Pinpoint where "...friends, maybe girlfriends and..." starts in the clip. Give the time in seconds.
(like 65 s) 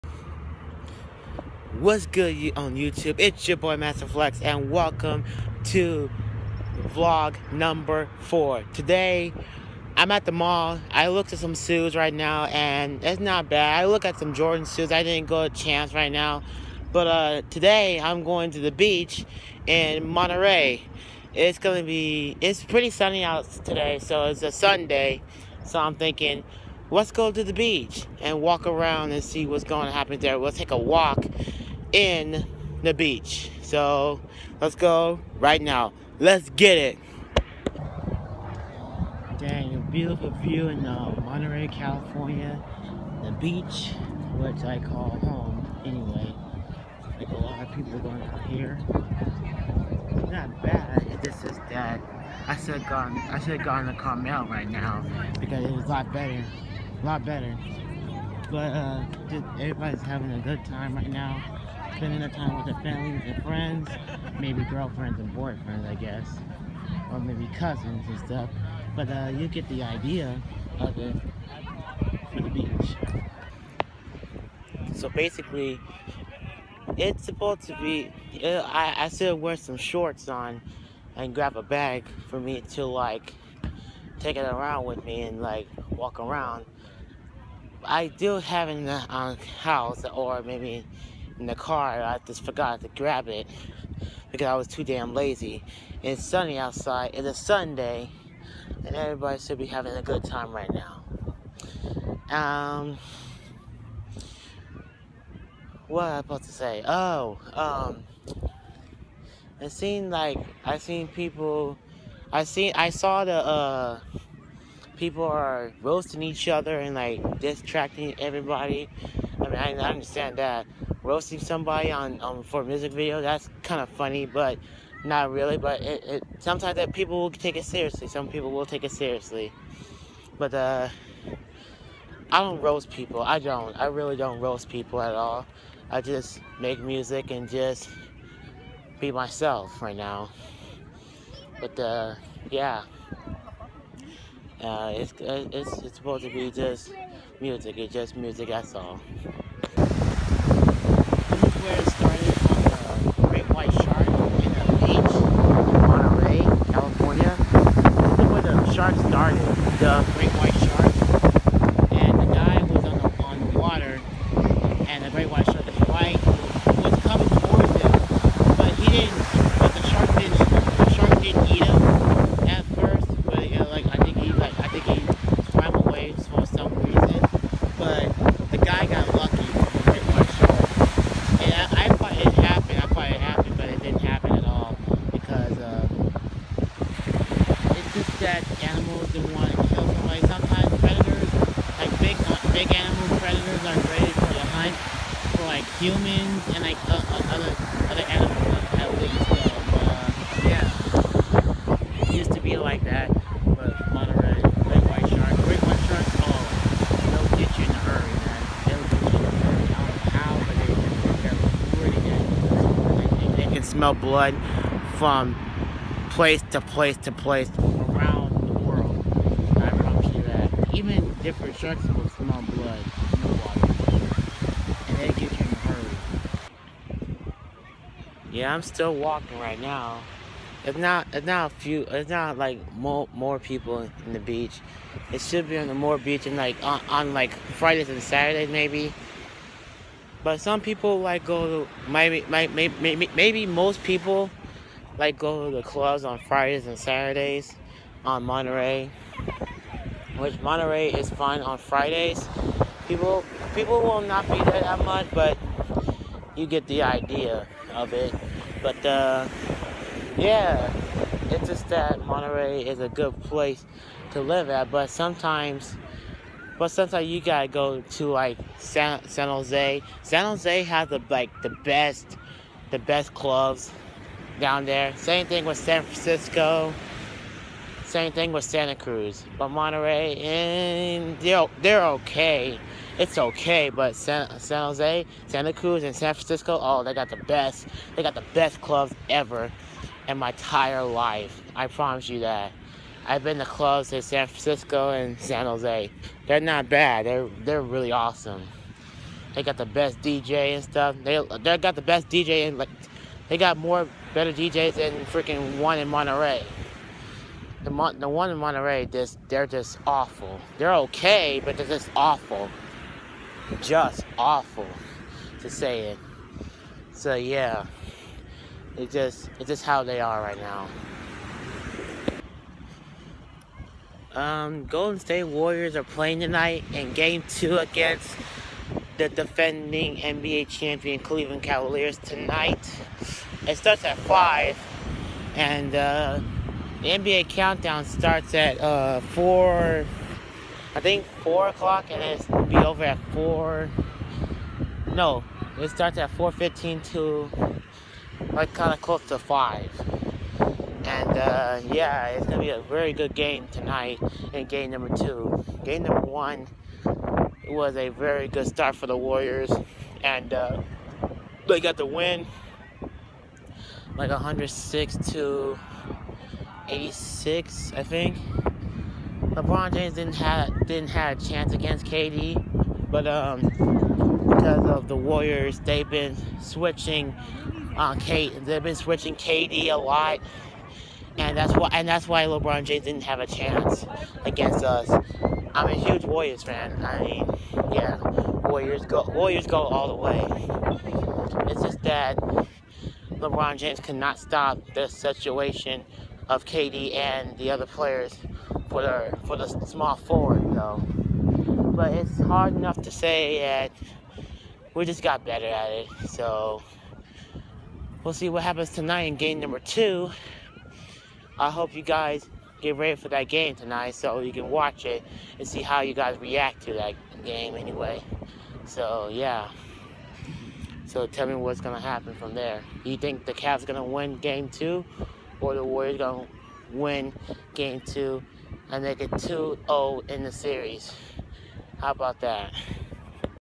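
63 s.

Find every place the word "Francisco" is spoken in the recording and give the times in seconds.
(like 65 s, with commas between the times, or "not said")
275 s, 286 s, 294 s.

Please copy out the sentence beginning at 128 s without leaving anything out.
Some people will take it seriously.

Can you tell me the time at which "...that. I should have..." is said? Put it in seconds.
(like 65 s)
51 s.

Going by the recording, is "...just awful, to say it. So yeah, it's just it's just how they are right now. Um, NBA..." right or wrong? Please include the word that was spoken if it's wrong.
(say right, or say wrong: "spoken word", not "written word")
wrong: "Golden", not "NBA".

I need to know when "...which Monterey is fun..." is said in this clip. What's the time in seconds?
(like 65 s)
250 s.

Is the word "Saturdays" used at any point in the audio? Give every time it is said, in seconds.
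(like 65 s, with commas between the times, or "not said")
238 s, 246 s.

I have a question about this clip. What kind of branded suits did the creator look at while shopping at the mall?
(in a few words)
Jordan suits.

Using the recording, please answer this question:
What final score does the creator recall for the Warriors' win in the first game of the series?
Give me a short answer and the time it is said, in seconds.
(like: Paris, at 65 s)
106 to 86, at 364 s.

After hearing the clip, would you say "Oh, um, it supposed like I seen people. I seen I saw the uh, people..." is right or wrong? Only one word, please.
wrong.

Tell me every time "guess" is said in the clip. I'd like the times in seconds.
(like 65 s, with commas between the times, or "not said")
65 s.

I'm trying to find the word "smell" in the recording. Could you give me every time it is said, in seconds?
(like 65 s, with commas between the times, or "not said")
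213 s, 222 s.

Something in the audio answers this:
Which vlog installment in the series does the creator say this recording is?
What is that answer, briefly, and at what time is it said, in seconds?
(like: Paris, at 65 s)
4, at 6 s.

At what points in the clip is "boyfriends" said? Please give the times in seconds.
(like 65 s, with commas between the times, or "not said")
65 s.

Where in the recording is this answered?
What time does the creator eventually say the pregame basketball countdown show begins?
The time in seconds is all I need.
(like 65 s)
346 s.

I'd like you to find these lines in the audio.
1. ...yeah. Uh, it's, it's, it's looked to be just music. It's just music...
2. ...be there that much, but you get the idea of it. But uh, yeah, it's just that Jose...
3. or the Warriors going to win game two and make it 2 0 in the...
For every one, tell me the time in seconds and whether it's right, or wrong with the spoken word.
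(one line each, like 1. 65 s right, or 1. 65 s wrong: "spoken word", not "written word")
1. 142 s wrong: "supposed", not "looked"
2. 254 s wrong: "Monterey", not "Jose"
3. 425 s right.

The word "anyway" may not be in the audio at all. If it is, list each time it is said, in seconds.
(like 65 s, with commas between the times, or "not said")
45 s, 417 s.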